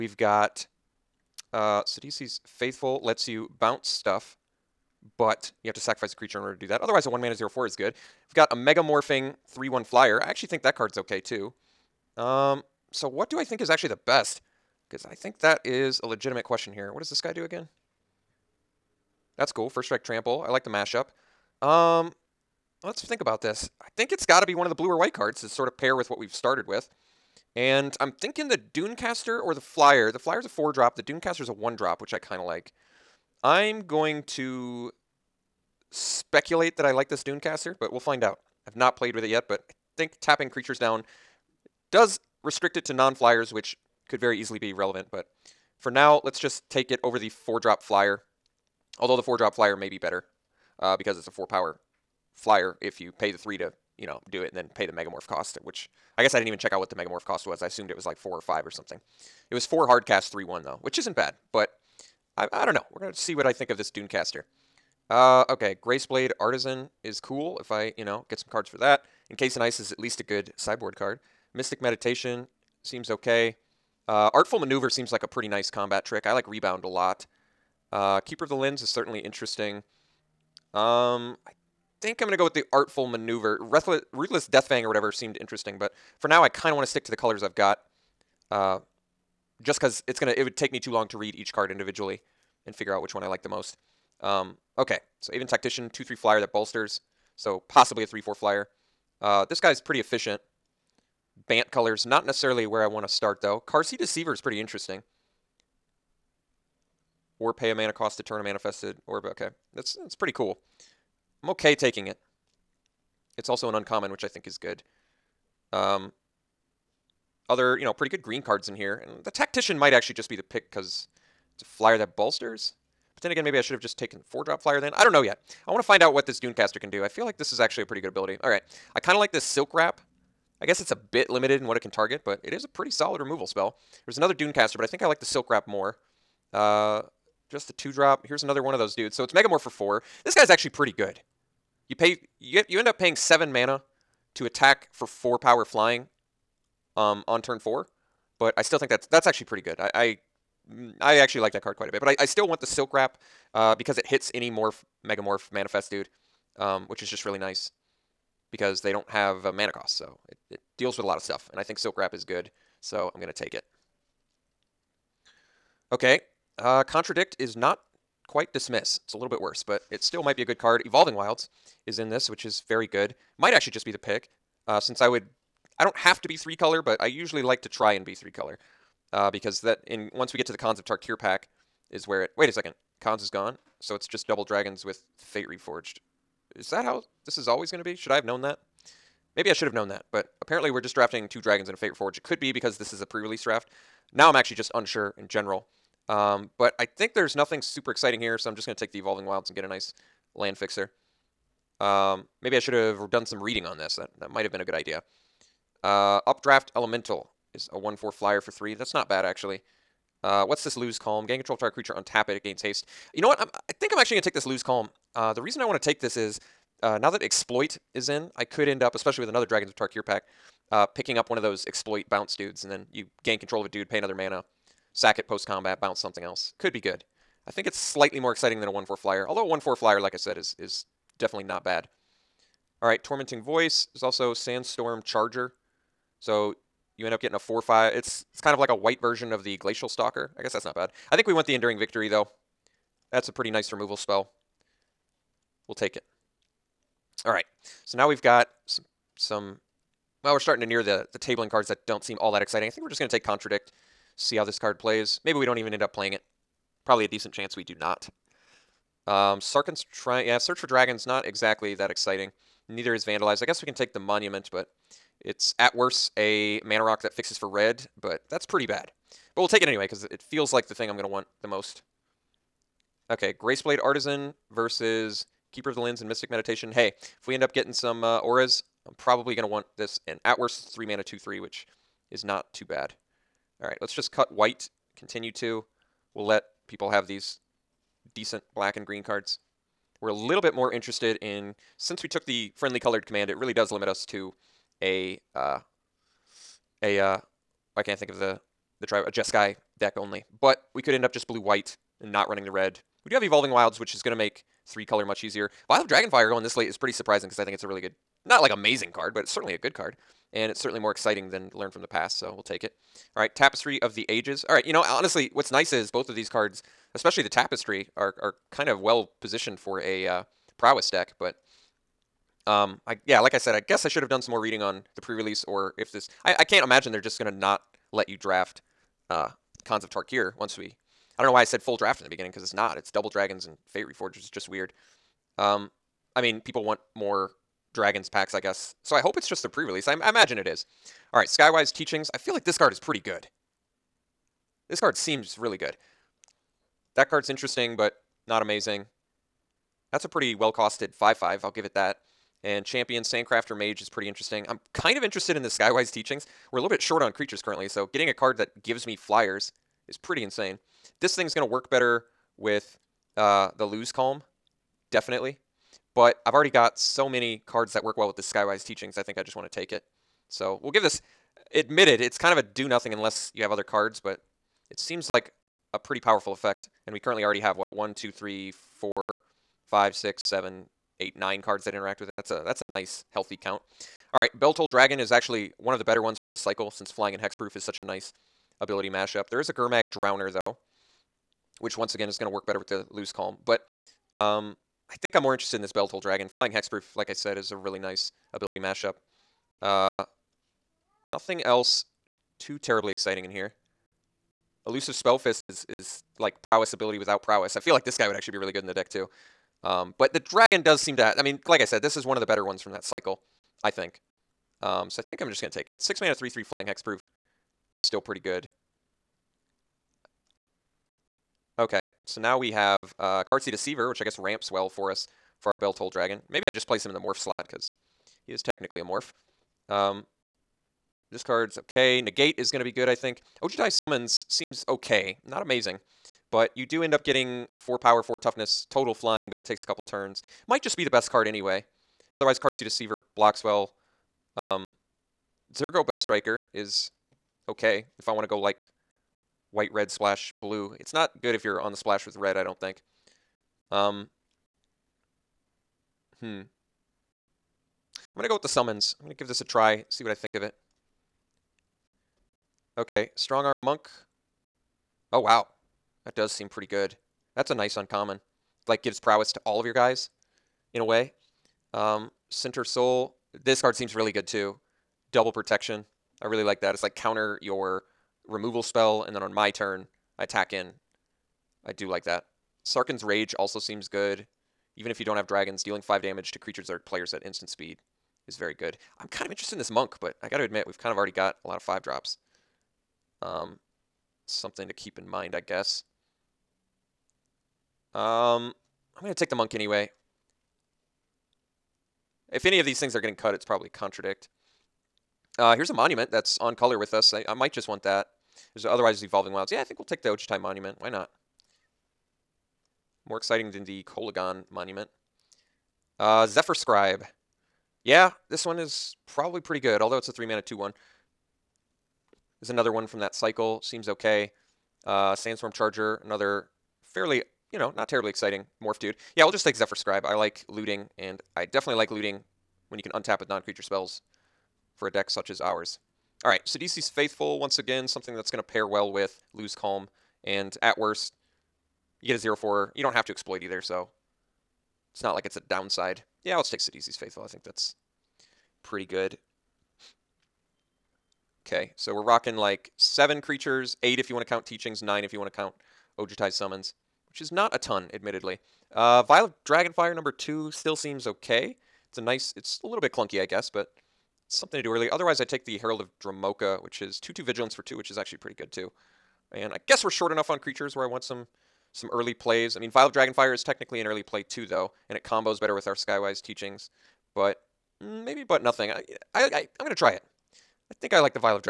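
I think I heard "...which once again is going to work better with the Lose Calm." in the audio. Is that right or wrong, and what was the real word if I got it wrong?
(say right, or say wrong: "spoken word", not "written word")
right.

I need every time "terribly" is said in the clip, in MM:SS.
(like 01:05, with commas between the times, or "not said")
06:42, 08:47.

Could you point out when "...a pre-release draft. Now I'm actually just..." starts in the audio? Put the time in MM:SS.
03:13.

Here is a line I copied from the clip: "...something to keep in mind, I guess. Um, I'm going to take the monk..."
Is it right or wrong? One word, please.
right.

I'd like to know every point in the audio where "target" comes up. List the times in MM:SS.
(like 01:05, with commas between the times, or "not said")
02:11, 03:31.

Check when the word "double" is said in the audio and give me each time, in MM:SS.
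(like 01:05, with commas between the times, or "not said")
03:04, 05:32, 07:55.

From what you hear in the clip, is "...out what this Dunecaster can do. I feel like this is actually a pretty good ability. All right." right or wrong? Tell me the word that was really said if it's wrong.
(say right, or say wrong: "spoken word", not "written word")
right.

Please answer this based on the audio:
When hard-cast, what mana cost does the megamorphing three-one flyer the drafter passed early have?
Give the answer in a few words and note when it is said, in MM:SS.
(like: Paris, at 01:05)
4, at 00:59.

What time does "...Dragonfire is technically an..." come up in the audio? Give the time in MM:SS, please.
09:32.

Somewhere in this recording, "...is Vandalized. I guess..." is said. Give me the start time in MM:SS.
04:22.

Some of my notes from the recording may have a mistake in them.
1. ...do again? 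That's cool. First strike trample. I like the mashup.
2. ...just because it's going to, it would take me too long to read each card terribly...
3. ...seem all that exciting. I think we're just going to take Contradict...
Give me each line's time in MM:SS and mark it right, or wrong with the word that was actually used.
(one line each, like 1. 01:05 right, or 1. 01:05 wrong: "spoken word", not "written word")
1. 00:17 right
2. 01:29 wrong: "individually", not "terribly"
3. 04:12 right.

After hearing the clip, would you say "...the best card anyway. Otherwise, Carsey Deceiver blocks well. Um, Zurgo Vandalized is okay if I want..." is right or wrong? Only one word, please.
wrong.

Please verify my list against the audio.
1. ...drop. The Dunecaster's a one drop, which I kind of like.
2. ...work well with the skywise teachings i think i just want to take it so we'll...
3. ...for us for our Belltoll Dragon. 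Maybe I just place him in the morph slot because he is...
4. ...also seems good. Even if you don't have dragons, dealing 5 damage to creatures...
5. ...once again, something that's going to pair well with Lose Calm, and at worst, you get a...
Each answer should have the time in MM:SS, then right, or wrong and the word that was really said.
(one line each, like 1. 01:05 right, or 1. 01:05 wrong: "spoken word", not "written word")
1. 00:30 right
2. 06:07 right
3. 07:04 right
4. 08:03 right
5. 08:57 right.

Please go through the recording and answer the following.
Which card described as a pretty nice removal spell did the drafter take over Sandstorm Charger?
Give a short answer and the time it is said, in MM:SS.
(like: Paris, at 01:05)
Enduring Victory, at 04:01.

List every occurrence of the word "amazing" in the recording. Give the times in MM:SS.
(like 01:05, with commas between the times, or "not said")
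05:08, 05:48, 07:15.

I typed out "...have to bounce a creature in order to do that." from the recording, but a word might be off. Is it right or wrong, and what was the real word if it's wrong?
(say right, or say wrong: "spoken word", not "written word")
wrong: "sacrifice", not "bounce".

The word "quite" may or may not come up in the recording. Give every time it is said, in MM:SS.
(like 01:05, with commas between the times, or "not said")
02:31, 02:48.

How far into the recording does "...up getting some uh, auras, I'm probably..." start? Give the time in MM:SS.
04:37.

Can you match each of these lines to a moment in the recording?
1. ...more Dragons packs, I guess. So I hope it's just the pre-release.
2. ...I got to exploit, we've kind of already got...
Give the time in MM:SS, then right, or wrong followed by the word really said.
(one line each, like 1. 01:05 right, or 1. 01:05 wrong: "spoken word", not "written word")
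1. 05:36 right
2. 08:10 wrong: "admit", not "exploit".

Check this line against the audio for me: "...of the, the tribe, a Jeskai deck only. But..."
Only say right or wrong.
right.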